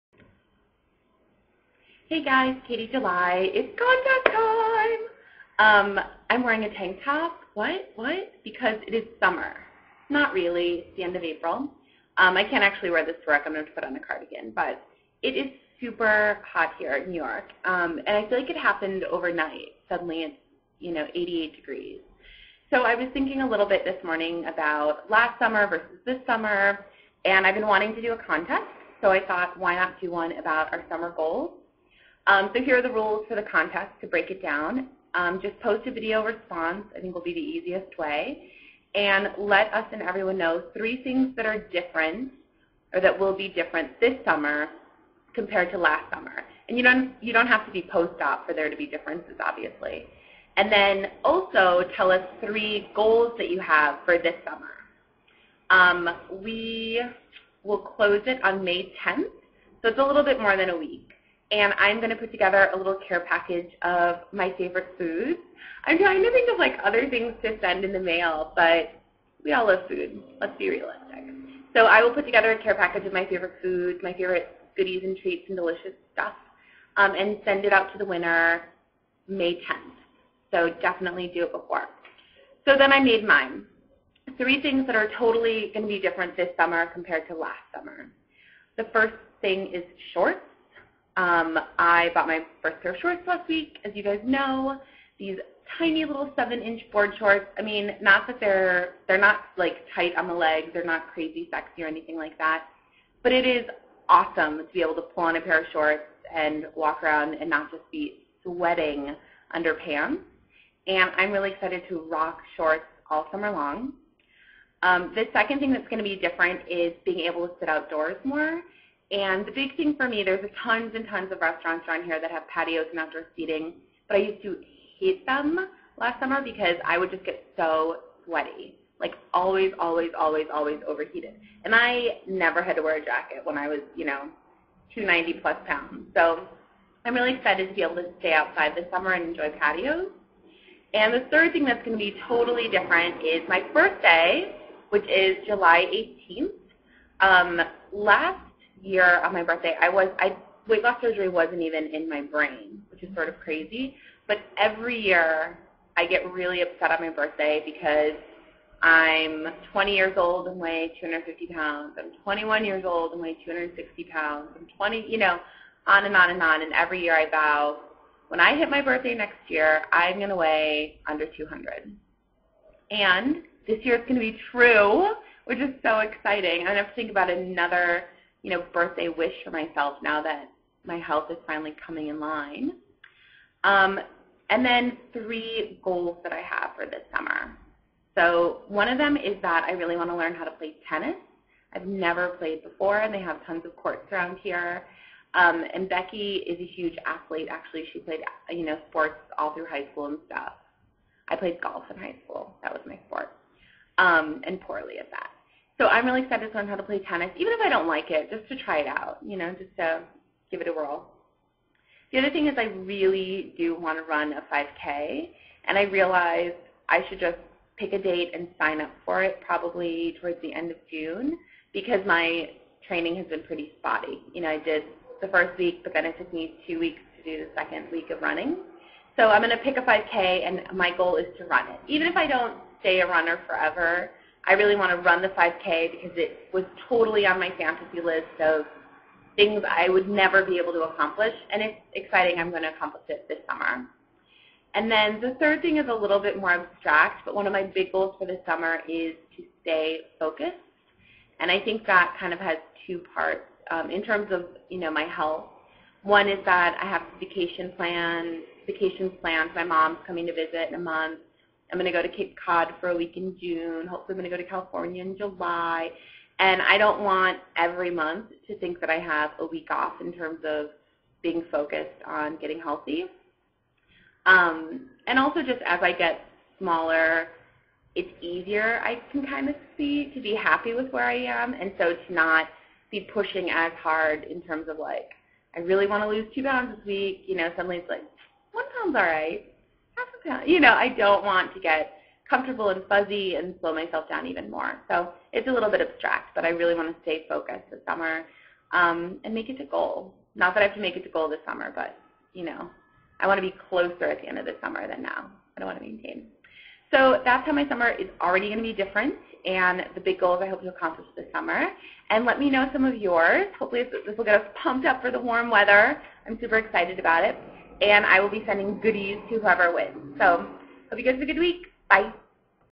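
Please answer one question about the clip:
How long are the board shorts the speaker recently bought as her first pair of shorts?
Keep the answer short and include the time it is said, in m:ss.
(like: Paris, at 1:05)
7 inches, at 1:36.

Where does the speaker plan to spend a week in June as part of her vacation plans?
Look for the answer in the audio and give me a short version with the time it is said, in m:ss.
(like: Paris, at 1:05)
Cape Cod, at 4:22.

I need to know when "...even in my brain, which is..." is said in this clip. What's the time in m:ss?
2:31.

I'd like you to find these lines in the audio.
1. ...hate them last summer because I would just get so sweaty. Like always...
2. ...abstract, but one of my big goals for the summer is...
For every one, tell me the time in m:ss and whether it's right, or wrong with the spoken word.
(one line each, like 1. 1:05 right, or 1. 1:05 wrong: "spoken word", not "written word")
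1. 2:04 right
2. 4:06 right.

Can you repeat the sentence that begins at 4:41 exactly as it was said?
And so to not be pushing as hard in terms of like, I really want to lose two pounds this week.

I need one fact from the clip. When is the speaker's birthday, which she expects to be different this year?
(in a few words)
July 18th.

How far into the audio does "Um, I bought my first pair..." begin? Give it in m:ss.
1:31.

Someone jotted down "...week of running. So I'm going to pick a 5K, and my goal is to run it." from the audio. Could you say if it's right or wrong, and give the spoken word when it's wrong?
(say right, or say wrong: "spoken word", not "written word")
right.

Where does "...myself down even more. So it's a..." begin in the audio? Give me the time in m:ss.
4:53.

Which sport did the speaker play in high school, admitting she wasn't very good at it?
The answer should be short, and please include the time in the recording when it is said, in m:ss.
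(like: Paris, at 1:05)
Golf, at 3:21.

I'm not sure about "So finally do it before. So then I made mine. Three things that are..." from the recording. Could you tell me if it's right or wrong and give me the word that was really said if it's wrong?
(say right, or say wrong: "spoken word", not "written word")
wrong: "definitely", not "finally".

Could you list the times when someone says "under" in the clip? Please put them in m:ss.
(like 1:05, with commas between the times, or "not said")
1:49, 2:51.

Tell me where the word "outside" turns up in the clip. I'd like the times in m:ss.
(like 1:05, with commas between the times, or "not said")
2:18.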